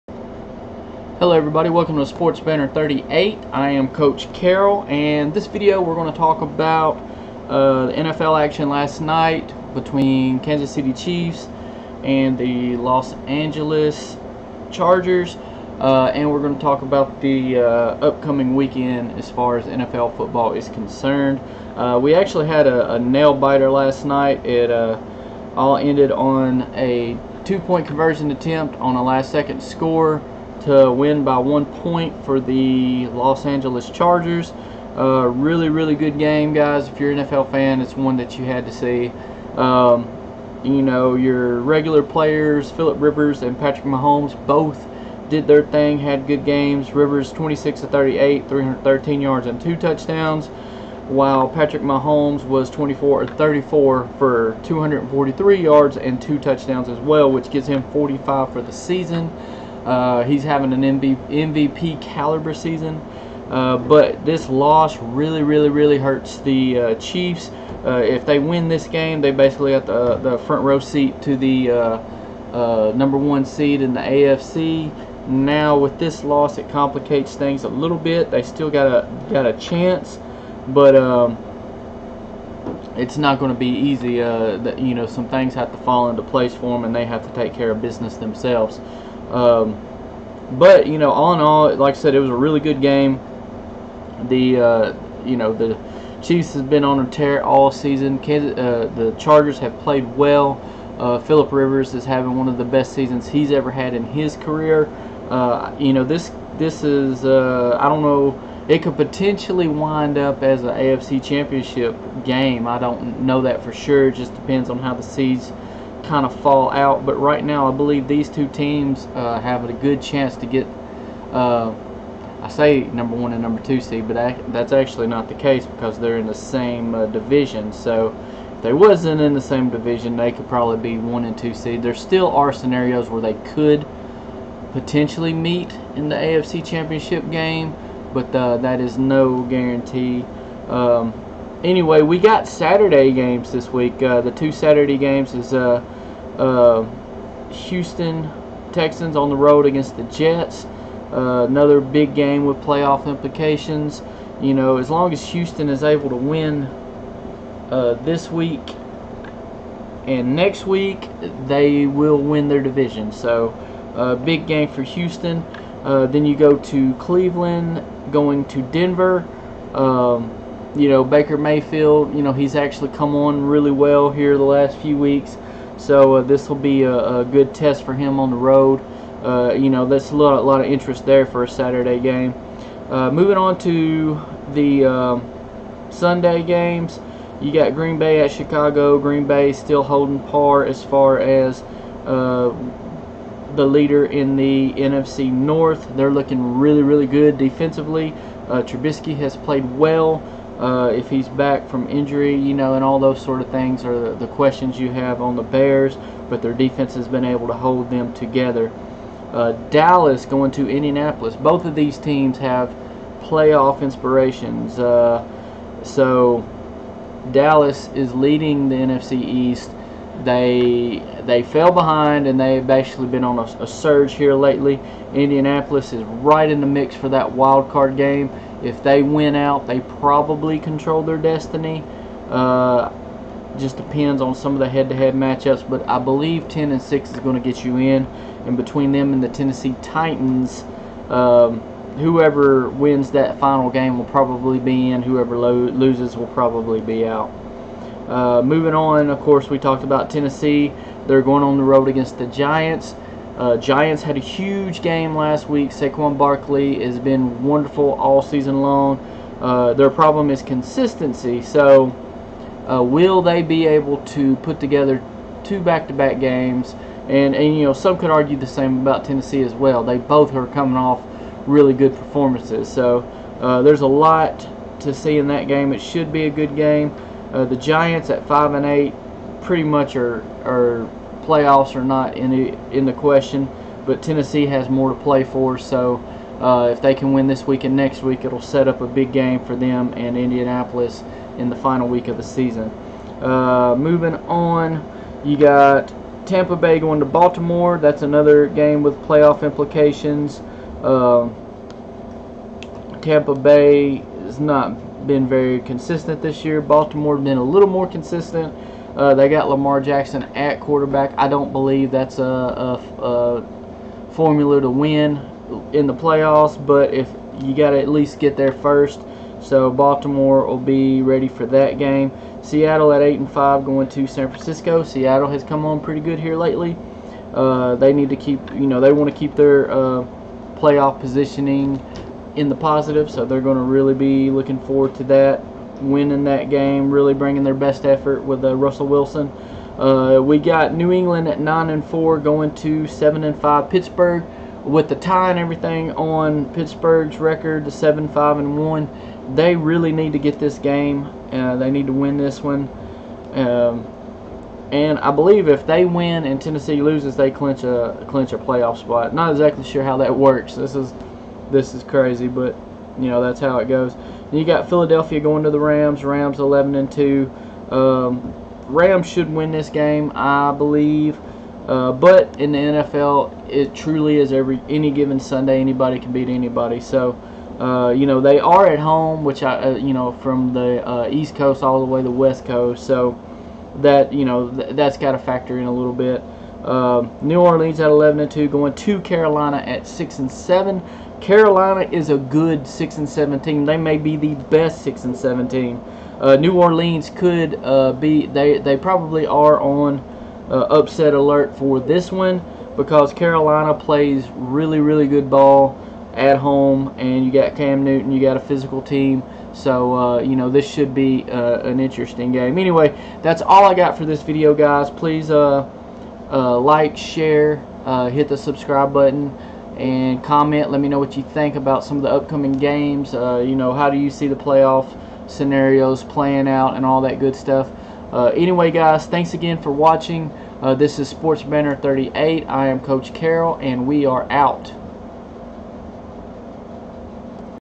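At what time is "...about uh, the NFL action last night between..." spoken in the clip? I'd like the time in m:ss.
0:06.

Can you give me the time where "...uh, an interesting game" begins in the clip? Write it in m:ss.
6:51.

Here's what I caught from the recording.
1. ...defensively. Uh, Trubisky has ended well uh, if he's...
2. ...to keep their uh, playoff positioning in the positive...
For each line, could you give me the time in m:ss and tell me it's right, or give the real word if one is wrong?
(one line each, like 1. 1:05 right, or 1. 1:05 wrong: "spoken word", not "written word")
1. 3:17 wrong: "played", not "ended"
2. 5:29 right.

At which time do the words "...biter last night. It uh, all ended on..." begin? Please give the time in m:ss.
0:23.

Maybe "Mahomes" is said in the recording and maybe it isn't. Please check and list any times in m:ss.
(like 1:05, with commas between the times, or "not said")
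0:43, 0:51.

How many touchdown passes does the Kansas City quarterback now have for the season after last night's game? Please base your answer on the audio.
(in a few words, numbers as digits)
45.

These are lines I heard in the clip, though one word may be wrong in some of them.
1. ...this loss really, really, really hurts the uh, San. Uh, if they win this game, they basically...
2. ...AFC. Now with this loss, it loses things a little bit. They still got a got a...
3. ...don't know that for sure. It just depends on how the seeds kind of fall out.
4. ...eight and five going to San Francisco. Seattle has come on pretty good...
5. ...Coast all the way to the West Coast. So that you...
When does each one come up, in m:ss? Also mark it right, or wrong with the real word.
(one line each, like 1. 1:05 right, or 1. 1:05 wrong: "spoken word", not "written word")
1. 1:04 wrong: "Chiefs", not "San"
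2. 1:13 wrong: "complicates", not "loses"
3. 1:52 right
4. 5:23 right
5. 6:21 right.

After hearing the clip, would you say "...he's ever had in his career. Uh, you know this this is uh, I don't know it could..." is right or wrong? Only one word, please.
right.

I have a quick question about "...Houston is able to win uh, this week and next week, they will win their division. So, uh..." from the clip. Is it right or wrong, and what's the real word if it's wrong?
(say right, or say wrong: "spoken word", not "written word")
right.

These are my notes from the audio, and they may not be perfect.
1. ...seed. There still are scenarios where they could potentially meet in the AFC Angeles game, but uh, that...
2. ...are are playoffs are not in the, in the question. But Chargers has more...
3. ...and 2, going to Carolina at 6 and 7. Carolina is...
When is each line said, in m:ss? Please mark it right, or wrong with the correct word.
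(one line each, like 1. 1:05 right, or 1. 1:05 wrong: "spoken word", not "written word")
1. 2:11 wrong: "Championship", not "Angeles"
2. 4:39 wrong: "Tennessee", not "Chargers"
3. 6:28 right.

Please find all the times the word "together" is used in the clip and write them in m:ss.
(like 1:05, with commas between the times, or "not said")
3:28, 4:24.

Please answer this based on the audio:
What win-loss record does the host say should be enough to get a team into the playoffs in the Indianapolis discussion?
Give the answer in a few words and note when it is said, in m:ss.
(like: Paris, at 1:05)
10 and 6, at 3:56.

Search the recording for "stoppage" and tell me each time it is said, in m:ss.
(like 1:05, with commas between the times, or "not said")
not said.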